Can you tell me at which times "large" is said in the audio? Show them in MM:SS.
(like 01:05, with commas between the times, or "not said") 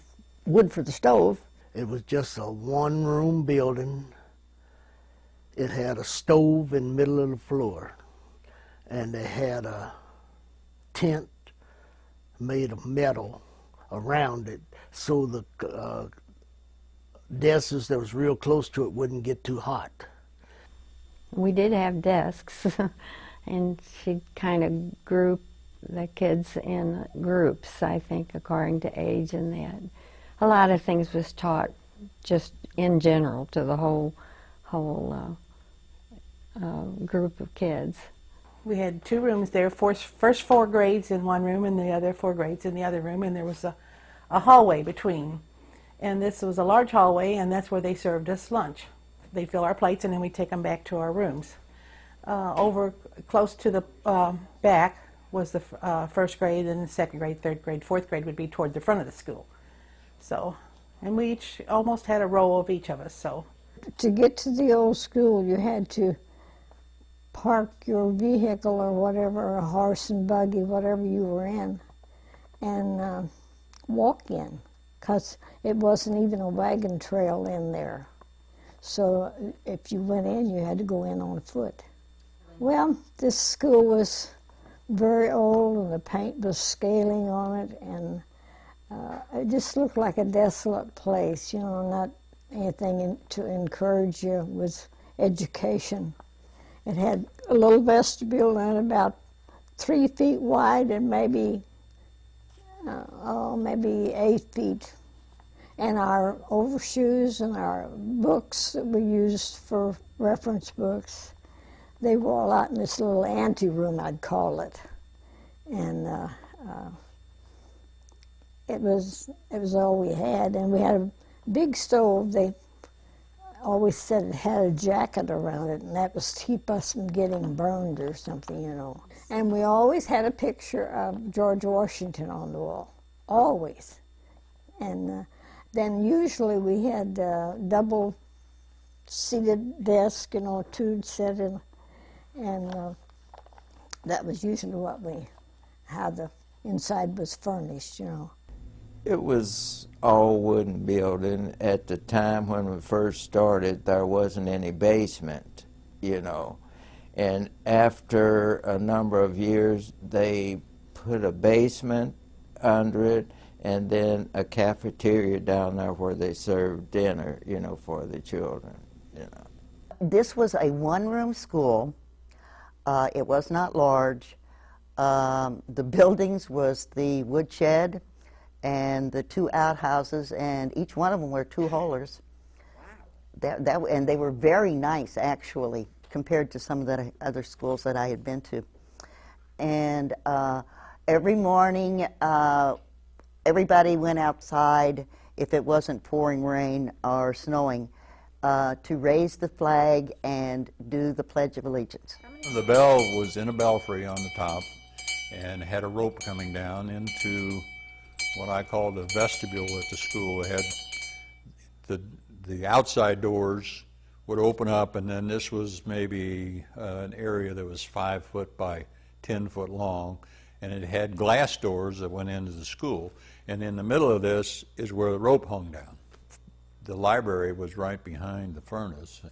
00:46, 02:53.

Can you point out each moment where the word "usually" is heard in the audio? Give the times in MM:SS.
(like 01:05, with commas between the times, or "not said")
02:16, 02:24.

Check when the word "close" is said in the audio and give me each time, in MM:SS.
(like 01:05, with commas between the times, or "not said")
00:18, 00:53.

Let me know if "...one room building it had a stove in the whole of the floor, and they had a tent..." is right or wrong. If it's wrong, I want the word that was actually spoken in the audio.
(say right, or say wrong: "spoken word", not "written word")
wrong: "middle", not "whole".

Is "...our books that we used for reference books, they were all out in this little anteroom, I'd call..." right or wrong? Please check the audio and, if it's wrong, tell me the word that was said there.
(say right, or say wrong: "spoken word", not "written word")
right.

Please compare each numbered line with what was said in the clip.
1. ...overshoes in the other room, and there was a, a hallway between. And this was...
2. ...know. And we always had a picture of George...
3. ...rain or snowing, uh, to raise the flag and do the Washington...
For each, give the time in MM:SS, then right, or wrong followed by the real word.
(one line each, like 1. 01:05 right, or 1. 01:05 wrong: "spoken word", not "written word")
1. 00:42 wrong: "grades", not "overshoes"
2. 02:08 right
3. 03:16 wrong: "Pledge", not "Washington".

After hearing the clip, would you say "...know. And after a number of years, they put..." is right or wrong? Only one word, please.
right.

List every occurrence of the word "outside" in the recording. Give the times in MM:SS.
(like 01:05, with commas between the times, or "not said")
03:14, 03:32.